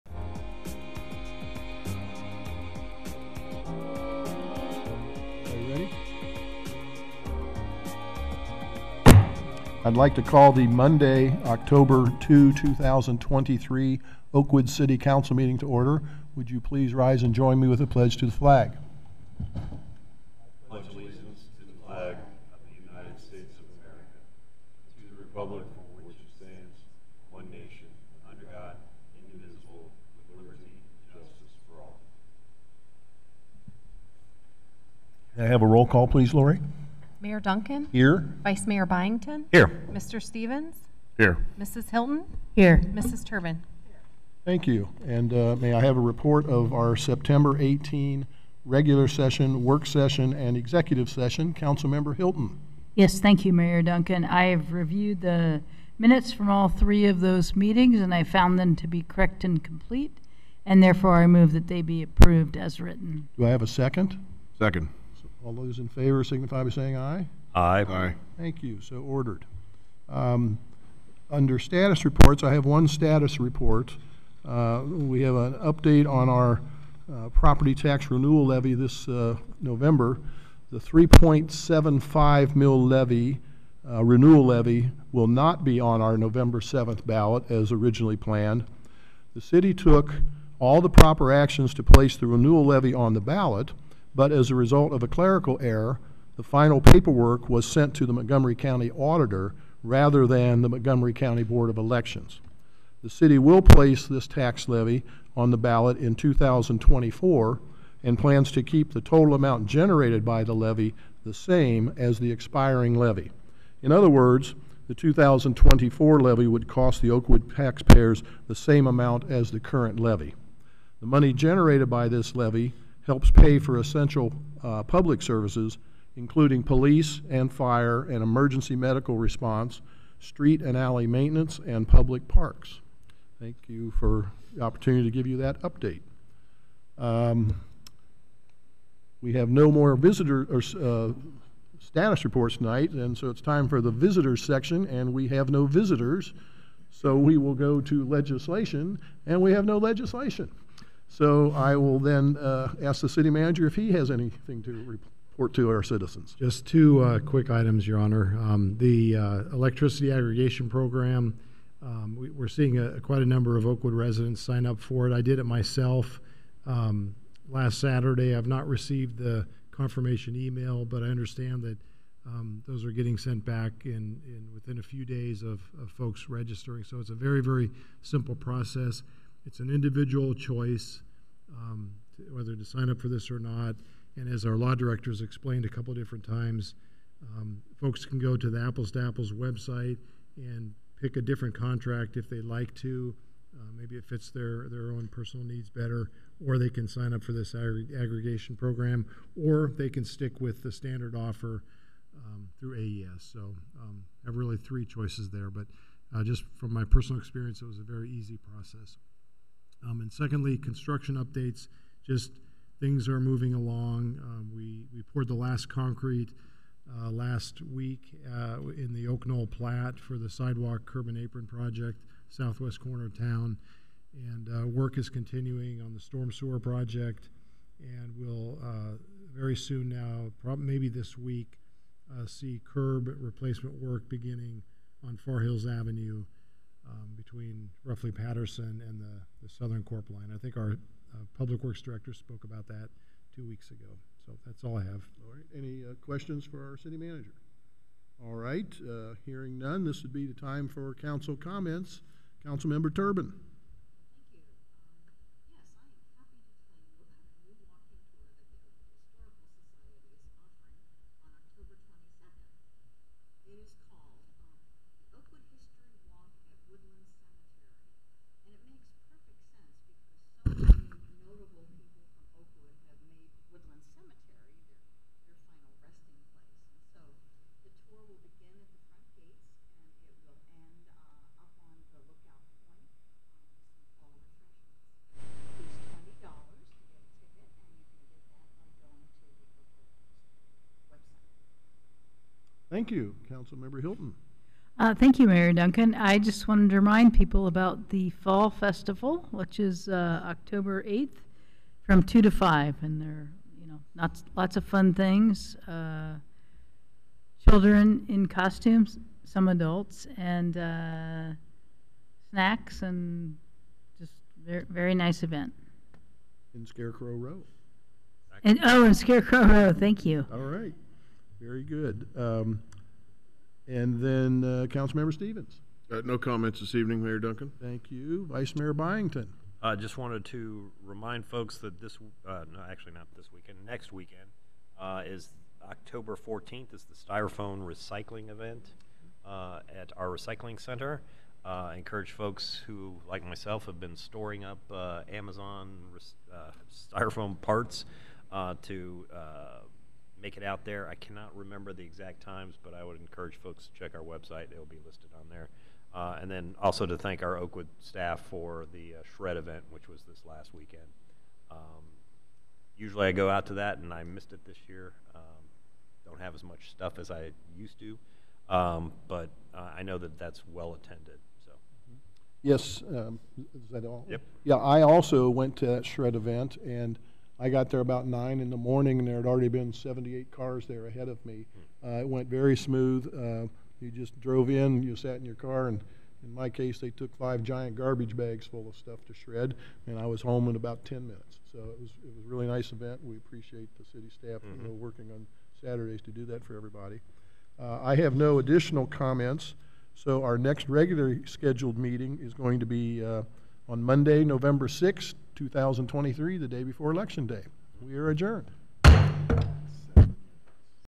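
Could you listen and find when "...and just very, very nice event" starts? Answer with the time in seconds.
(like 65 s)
312 s.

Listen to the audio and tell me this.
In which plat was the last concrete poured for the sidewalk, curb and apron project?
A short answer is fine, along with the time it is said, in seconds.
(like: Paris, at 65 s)
Oak Knoll Plat, at 219 s.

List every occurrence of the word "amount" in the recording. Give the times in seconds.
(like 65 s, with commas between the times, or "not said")
109 s, 118 s.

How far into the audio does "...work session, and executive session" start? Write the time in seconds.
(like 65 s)
49 s.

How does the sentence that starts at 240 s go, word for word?
I think our uh, Public Works Director spoke about that two weeks ago.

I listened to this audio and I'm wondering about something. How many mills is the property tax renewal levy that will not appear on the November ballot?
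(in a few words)
3.75 mil.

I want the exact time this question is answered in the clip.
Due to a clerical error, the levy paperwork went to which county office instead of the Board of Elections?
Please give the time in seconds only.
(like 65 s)
98 s.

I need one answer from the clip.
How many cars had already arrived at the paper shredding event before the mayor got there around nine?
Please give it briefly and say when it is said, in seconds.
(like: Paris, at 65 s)
78, at 379 s.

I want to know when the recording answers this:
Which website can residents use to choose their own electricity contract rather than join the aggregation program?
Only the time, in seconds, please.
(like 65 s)
188 s.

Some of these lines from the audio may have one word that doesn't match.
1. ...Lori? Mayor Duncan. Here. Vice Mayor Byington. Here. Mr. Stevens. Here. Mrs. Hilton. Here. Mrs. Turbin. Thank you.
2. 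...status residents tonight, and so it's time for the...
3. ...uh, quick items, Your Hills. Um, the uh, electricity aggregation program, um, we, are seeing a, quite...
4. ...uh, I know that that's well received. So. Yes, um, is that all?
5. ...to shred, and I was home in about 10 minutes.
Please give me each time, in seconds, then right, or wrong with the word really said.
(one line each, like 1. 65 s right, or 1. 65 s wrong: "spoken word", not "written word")
1. 36 s right
2. 141 s wrong: "reports", not "residents"
3. 157 s wrong: "Honor", not "Hills"
4. 369 s wrong: "attended", not "received"
5. 389 s right.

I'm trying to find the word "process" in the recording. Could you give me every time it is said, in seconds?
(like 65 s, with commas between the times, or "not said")
178 s, 208 s.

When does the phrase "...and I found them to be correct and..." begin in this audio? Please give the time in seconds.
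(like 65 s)
58 s.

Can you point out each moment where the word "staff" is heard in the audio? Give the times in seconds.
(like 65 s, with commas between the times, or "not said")
357 s, 394 s.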